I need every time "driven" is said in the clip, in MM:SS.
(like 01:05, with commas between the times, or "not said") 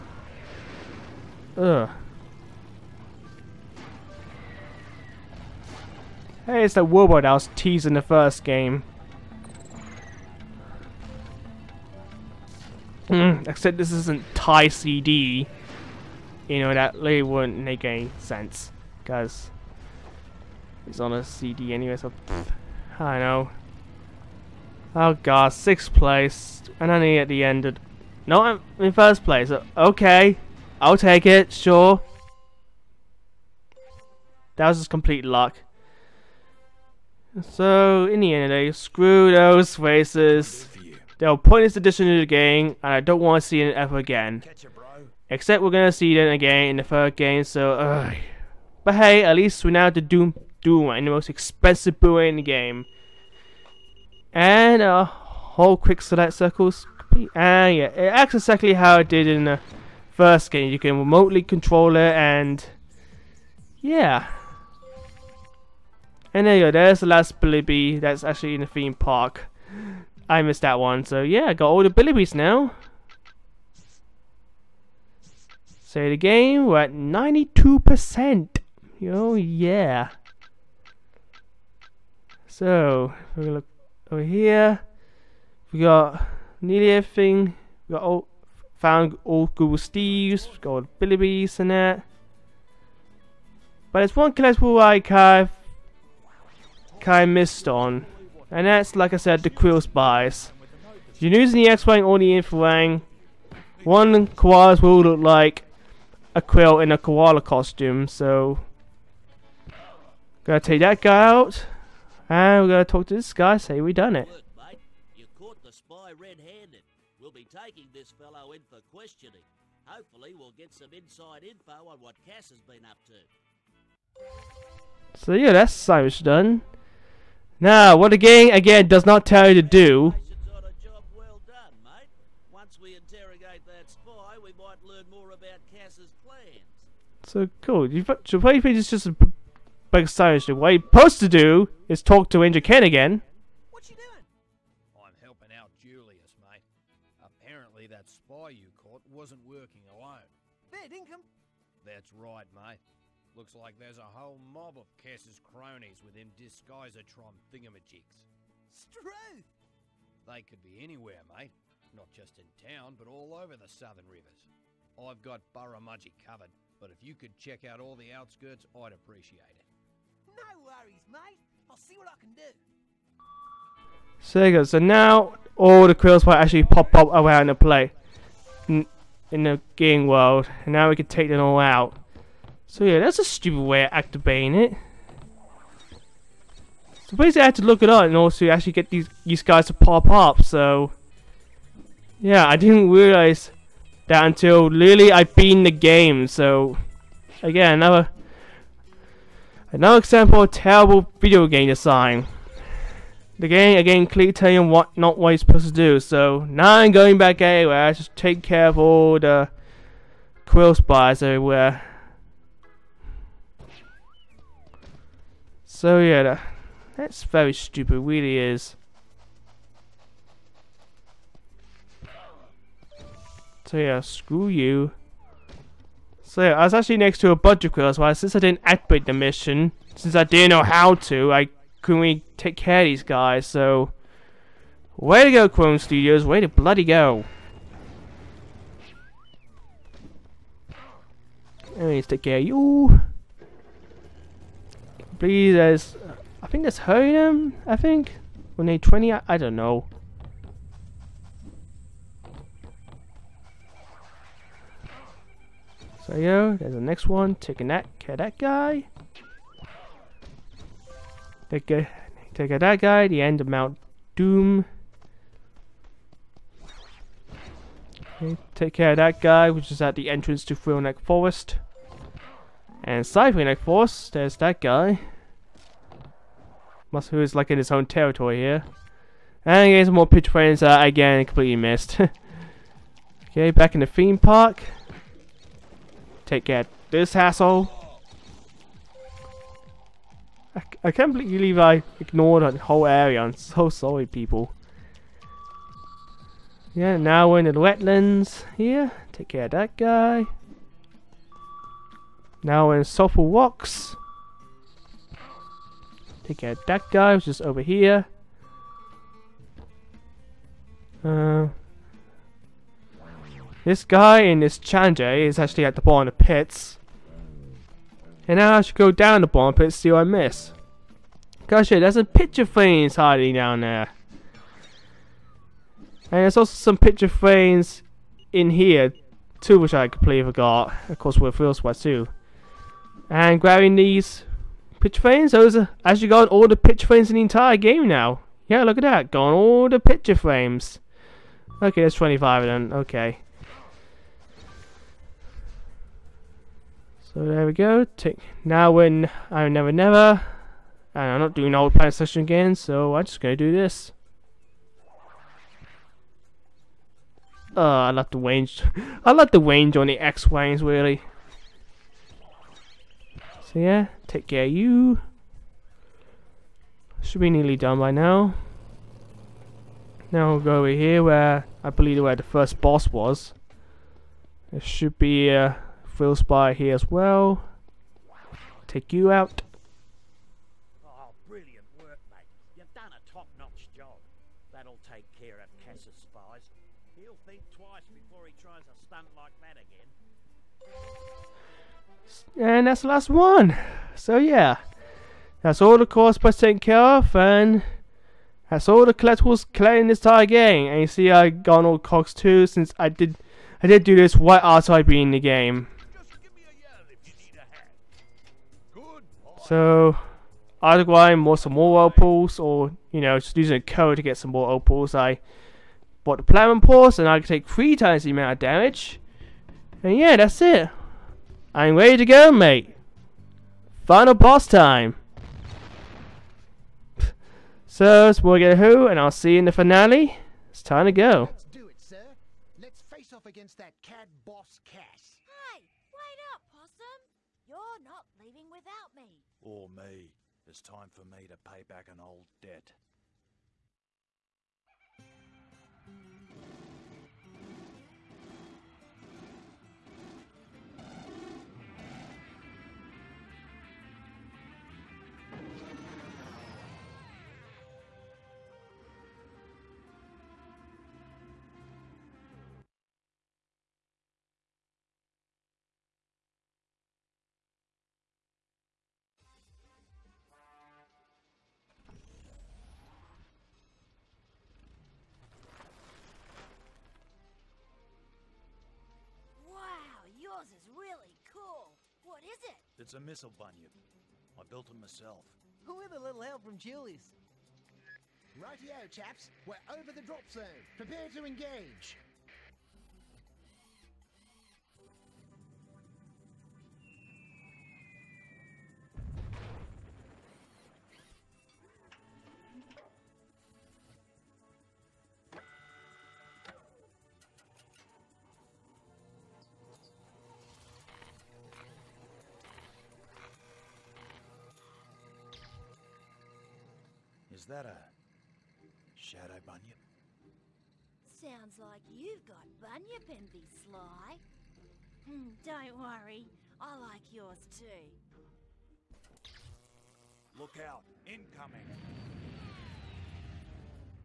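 not said.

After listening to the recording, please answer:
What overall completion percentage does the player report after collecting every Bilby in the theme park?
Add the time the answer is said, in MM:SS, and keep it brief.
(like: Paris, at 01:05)
92%, at 01:16.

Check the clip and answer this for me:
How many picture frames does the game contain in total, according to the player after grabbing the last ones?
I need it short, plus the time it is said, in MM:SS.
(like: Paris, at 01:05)
25, at 05:41.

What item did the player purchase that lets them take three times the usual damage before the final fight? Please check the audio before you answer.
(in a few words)
platinum pulse.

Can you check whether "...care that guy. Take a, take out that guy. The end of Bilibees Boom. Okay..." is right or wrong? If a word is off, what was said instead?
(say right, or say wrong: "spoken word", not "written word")
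wrong: "Mount", not "Bilibees".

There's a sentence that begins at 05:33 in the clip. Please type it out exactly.
And grabbing these picture frames, those are actually got all the picture frames in the entire game now.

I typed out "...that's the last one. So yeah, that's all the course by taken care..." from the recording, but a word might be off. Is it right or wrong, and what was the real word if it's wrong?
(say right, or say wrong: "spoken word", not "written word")
right.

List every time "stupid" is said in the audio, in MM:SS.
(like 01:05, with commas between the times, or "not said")
03:03, 03:37.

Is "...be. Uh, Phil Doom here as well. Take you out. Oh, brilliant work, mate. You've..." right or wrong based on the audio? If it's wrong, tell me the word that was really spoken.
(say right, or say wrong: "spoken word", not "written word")
wrong: "Spy", not "Doom".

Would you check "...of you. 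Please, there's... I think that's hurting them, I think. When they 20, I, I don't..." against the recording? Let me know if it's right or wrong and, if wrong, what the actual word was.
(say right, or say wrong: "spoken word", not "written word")
right.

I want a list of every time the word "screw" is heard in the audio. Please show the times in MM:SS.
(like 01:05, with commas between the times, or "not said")
00:38, 03:44.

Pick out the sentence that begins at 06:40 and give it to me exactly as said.
And you see, I have gone all Cox 2 since I did, I did do this right after I beat the game.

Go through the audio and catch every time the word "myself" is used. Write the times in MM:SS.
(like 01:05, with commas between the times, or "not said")
08:04.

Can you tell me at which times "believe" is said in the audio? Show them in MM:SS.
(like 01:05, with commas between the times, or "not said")
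04:51, 06:11.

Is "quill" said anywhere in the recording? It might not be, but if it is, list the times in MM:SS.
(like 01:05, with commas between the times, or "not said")
01:39, 01:46, 02:55, 03:30, 03:47.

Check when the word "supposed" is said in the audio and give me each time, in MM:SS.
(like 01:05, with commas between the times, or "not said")
02:20, 03:25.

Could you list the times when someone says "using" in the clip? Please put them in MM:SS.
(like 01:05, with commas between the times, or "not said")
01:41, 06:53.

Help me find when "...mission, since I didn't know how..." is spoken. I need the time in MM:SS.
03:49.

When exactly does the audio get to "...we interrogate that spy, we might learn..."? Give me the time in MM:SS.
02:12.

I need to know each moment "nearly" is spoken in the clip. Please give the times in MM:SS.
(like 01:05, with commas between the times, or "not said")
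01:26, 06:07.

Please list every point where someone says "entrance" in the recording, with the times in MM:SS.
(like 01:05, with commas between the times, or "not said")
04:30.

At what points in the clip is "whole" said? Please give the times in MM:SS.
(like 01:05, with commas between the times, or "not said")
00:55, 02:34, 04:52.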